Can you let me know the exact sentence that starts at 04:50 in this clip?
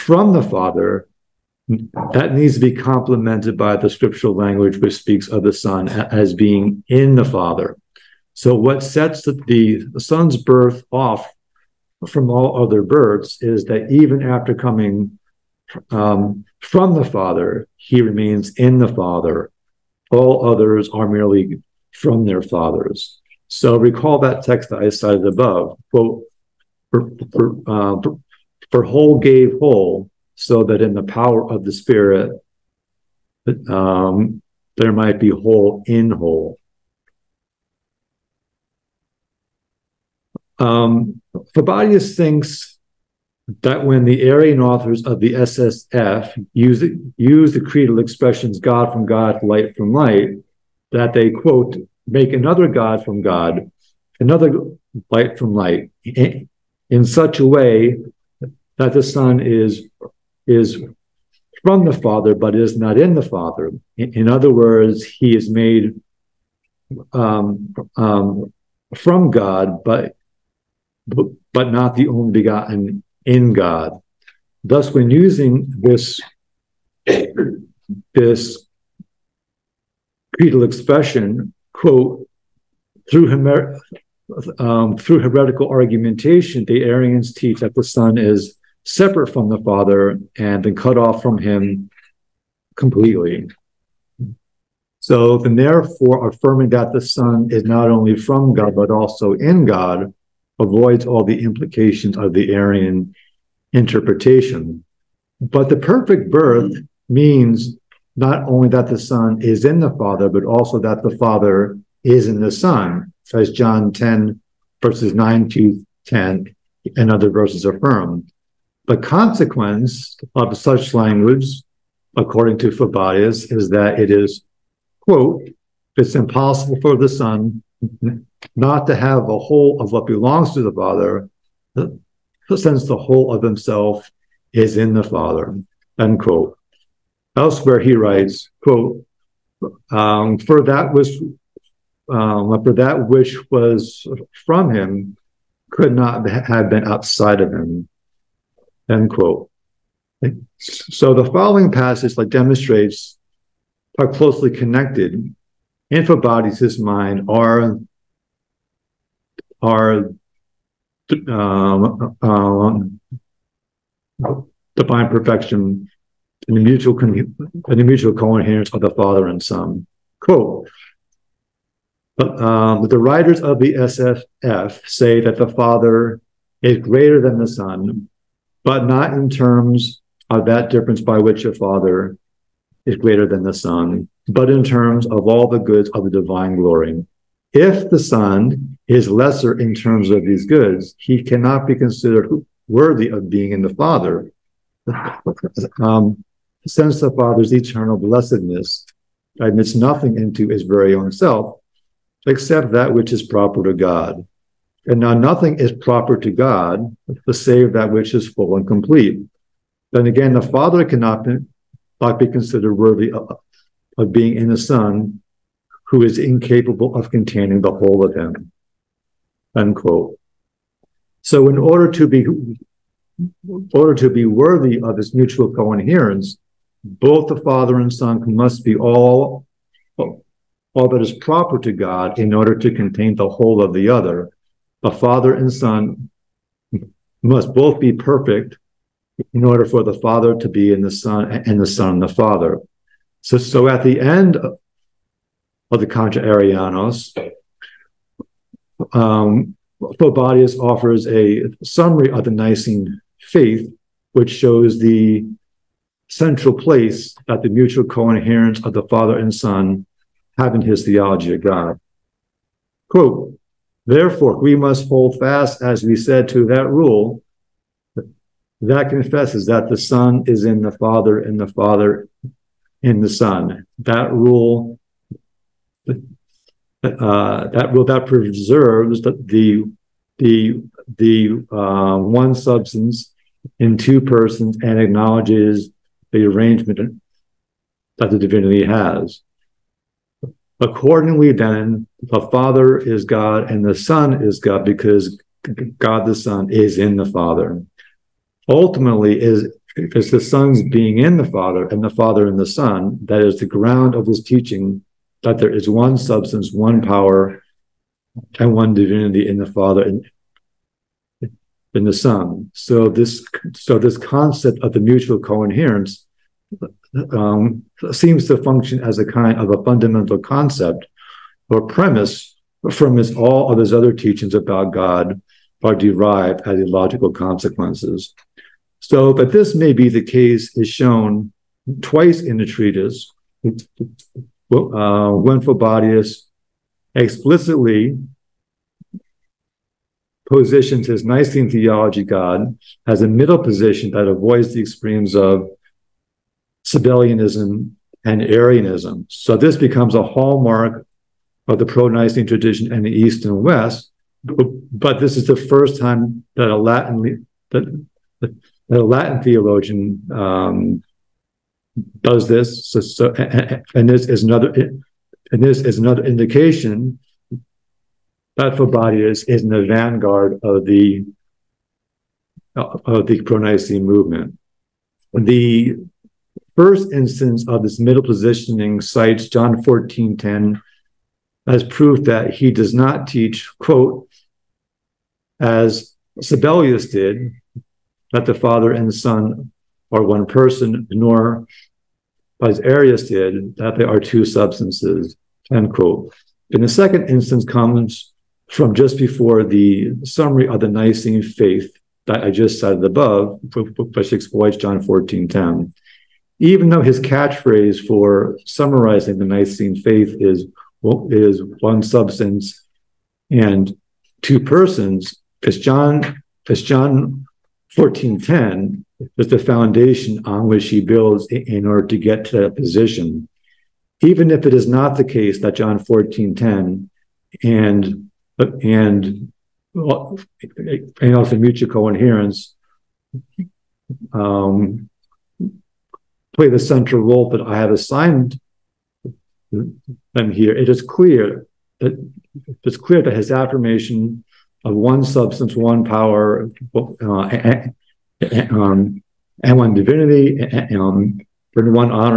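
Accordingly, then, the Father is God and the Son is God because God the Son is in the Father.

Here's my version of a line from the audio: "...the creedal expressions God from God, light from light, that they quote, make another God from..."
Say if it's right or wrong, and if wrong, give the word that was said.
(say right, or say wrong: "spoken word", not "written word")
right.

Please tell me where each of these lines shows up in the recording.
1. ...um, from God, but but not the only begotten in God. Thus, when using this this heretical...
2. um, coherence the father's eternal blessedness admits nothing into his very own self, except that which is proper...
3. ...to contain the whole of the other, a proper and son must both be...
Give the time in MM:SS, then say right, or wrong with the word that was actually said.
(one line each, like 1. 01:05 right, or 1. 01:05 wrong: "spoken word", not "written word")
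1. 01:07 wrong: "creedal", not "heretical"
2. 03:15 wrong: "since", not "coherence"
3. 03:52 wrong: "father", not "proper".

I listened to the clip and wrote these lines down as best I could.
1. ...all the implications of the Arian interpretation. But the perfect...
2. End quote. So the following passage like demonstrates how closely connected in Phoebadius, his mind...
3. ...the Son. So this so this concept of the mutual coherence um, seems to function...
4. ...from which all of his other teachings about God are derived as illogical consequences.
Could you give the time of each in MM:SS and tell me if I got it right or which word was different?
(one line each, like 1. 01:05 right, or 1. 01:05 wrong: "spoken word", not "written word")
1. 01:41 right
2. 02:28 right
3. 05:11 right
4. 05:22 right.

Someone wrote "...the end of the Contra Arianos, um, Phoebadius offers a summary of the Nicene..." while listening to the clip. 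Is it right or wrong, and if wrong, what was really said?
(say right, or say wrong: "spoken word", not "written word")
right.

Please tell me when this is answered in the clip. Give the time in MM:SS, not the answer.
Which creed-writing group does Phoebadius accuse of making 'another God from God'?
00:44.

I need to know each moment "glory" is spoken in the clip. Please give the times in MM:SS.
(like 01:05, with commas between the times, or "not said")
03:06.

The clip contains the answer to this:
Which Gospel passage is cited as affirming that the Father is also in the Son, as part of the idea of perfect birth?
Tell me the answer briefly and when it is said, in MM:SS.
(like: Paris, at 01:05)
John 10:9-10, at 01:53.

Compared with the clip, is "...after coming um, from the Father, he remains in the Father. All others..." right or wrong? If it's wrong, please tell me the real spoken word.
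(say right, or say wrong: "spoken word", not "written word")
right.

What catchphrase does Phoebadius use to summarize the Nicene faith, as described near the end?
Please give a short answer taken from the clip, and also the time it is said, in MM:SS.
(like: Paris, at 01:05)
One substance and two persons, at 06:51.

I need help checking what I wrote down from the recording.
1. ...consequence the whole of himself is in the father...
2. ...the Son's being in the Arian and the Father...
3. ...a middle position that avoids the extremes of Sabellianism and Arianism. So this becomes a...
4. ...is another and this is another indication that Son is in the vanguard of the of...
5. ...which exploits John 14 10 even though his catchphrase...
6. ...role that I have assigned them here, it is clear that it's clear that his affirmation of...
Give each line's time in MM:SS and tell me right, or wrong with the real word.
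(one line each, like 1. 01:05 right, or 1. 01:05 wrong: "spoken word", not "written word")
1. 02:12 wrong: "since", not "consequence"
2. 05:00 wrong: "Father", not "Arian"
3. 05:43 right
4. 06:04 wrong: "Phoebadius", not "Son"
5. 06:43 right
6. 07:17 right.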